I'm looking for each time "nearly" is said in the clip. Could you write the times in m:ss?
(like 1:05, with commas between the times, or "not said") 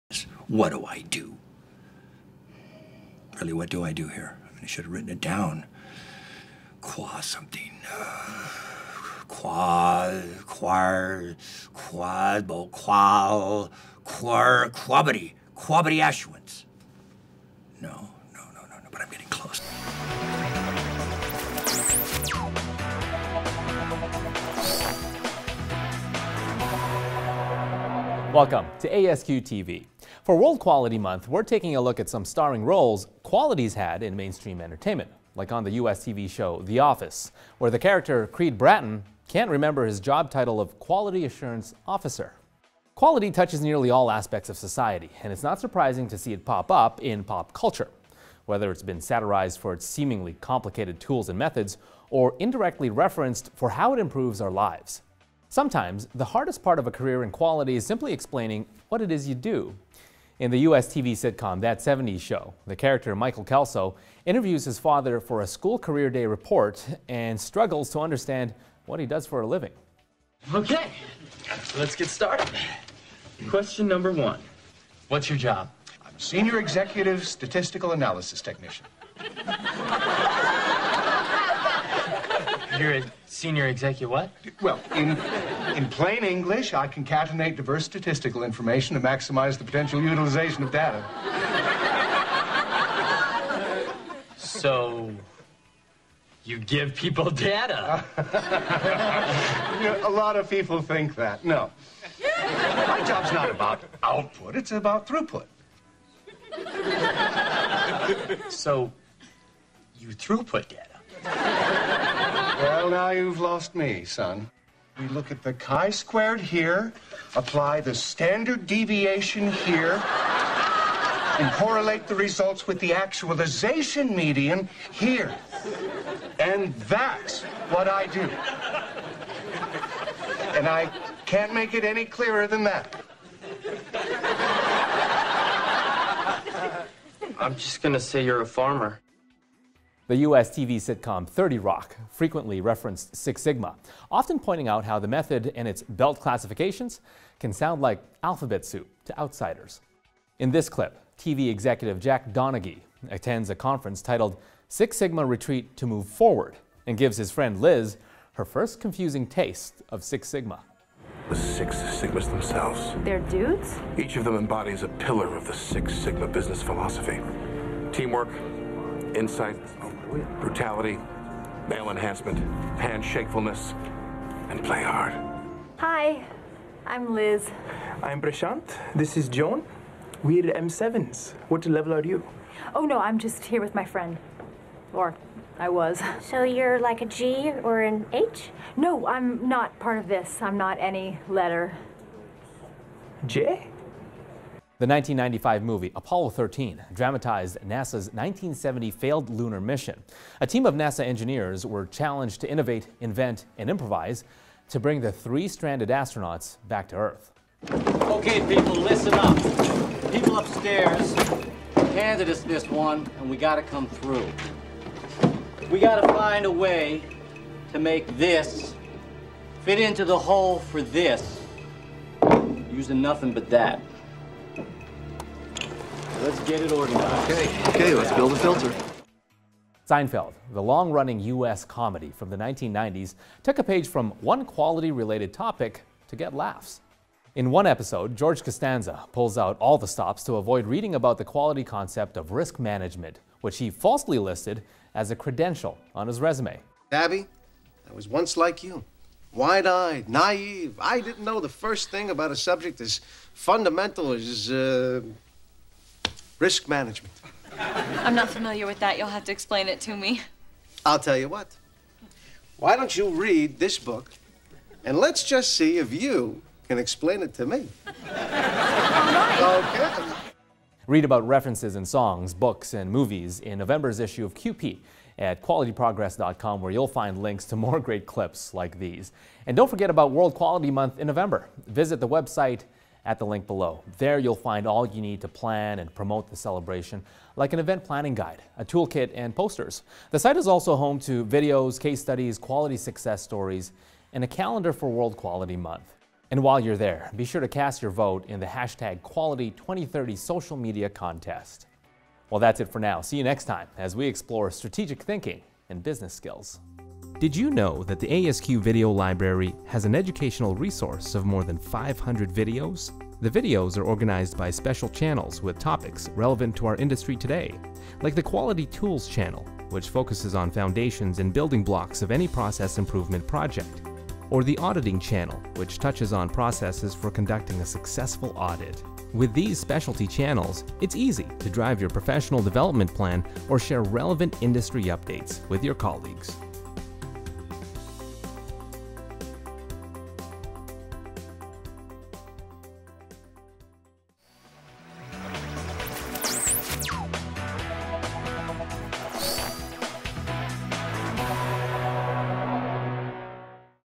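0:43.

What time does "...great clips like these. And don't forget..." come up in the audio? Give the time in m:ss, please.
4:37.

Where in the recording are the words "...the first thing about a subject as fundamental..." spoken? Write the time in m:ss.
4:11.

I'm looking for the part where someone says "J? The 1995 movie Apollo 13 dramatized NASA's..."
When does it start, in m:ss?
3:13.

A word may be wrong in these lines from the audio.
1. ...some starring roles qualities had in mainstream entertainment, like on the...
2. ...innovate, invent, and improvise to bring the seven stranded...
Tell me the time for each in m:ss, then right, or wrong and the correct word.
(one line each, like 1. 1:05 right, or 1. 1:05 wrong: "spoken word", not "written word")
1. 0:32 right
2. 3:22 wrong: "three", not "seven".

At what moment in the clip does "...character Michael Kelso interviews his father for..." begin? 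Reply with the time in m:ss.
1:02.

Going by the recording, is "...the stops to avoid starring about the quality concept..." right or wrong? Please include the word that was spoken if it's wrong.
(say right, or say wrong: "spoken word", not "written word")
wrong: "reading", not "starring".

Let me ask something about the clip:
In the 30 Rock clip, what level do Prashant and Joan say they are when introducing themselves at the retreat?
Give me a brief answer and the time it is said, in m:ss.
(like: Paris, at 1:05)
M7s, at 3:00.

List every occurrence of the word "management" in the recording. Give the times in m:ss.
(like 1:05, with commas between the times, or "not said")
4:02, 4:16.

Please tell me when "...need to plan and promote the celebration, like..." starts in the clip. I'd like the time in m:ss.
4:45.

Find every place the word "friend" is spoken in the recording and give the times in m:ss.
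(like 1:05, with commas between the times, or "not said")
2:37, 3:03.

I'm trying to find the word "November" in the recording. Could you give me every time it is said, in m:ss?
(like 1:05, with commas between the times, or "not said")
4:33, 4:41.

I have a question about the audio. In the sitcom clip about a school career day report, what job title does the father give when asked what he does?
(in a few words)
Senior Executive Statistical Analysis Technician.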